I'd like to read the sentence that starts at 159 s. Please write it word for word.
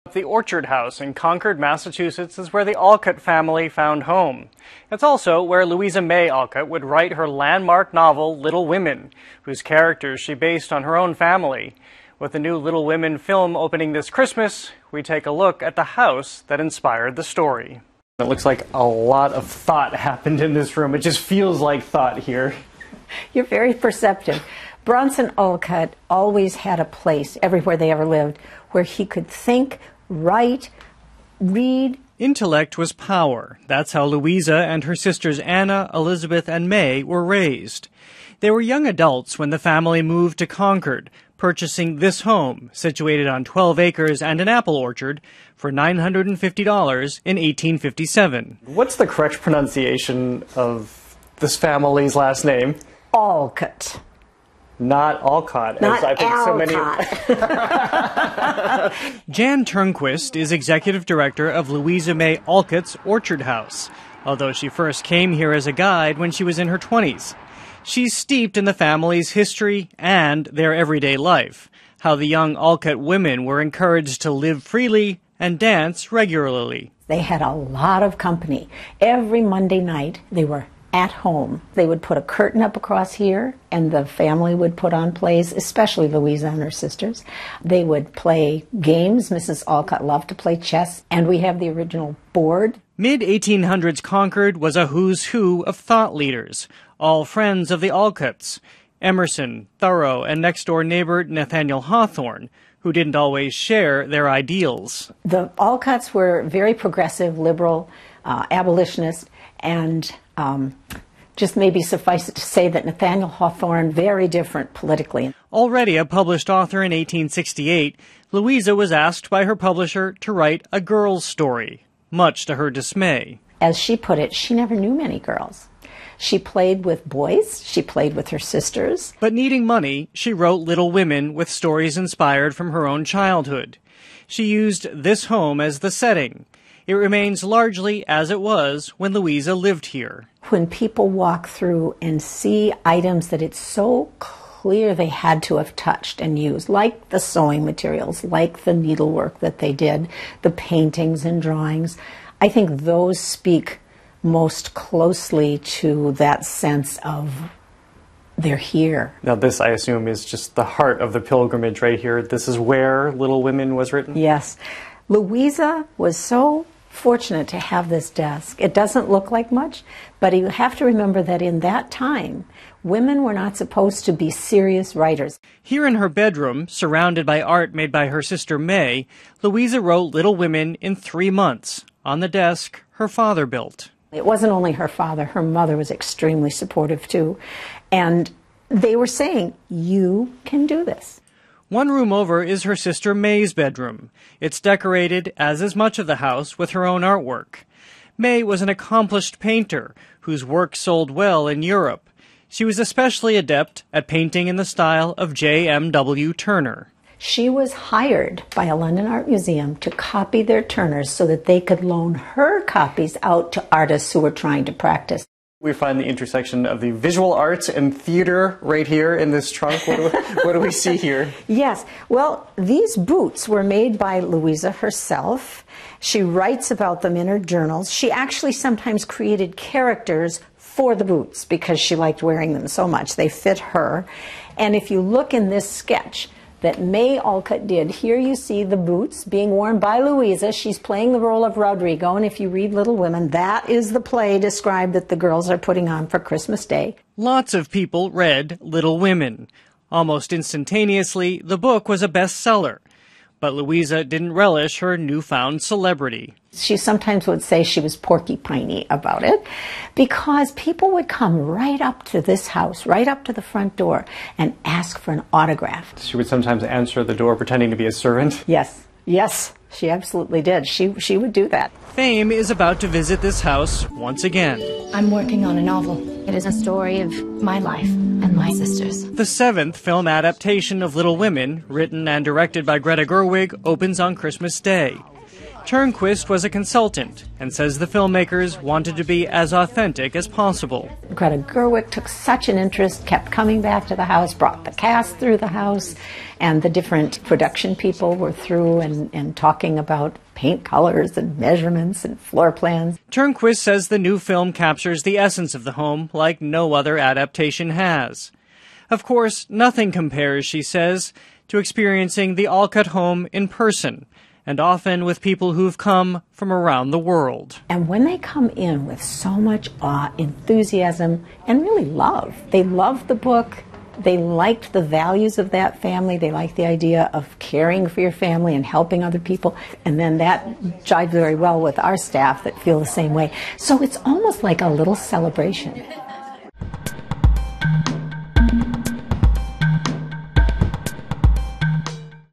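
Now, this, I assume, is just the heart of the pilgrimage right here.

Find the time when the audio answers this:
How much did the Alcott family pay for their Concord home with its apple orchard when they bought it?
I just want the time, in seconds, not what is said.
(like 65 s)
45 s.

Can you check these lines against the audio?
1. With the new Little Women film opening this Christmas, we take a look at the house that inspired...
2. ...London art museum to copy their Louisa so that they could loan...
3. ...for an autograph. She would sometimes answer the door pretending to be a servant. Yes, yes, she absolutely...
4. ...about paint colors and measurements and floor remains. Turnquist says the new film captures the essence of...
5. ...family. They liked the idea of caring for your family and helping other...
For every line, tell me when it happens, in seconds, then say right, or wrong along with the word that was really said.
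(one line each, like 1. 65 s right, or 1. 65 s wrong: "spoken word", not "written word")
1. 12 s right
2. 208 s wrong: "Turners", not "Louisa"
3. 264 s right
4. 299 s wrong: "plans", not "remains"
5. 325 s right.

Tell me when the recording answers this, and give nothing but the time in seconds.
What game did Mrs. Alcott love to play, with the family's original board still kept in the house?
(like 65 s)
90 s.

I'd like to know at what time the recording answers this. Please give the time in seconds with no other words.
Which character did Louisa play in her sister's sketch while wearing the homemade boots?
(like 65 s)
241 s.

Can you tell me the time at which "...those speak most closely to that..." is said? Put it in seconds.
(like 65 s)
152 s.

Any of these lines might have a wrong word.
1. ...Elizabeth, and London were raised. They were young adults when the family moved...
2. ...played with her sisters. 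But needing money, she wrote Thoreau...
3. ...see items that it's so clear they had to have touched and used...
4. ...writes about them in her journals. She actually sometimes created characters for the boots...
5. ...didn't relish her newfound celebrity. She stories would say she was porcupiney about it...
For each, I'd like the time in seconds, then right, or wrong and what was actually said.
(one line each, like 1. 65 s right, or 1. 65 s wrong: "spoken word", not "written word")
1. 35 s wrong: "May", not "London"
2. 127 s wrong: "Little", not "Thoreau"
3. 142 s right
4. 226 s right
5. 254 s wrong: "sometimes", not "stories".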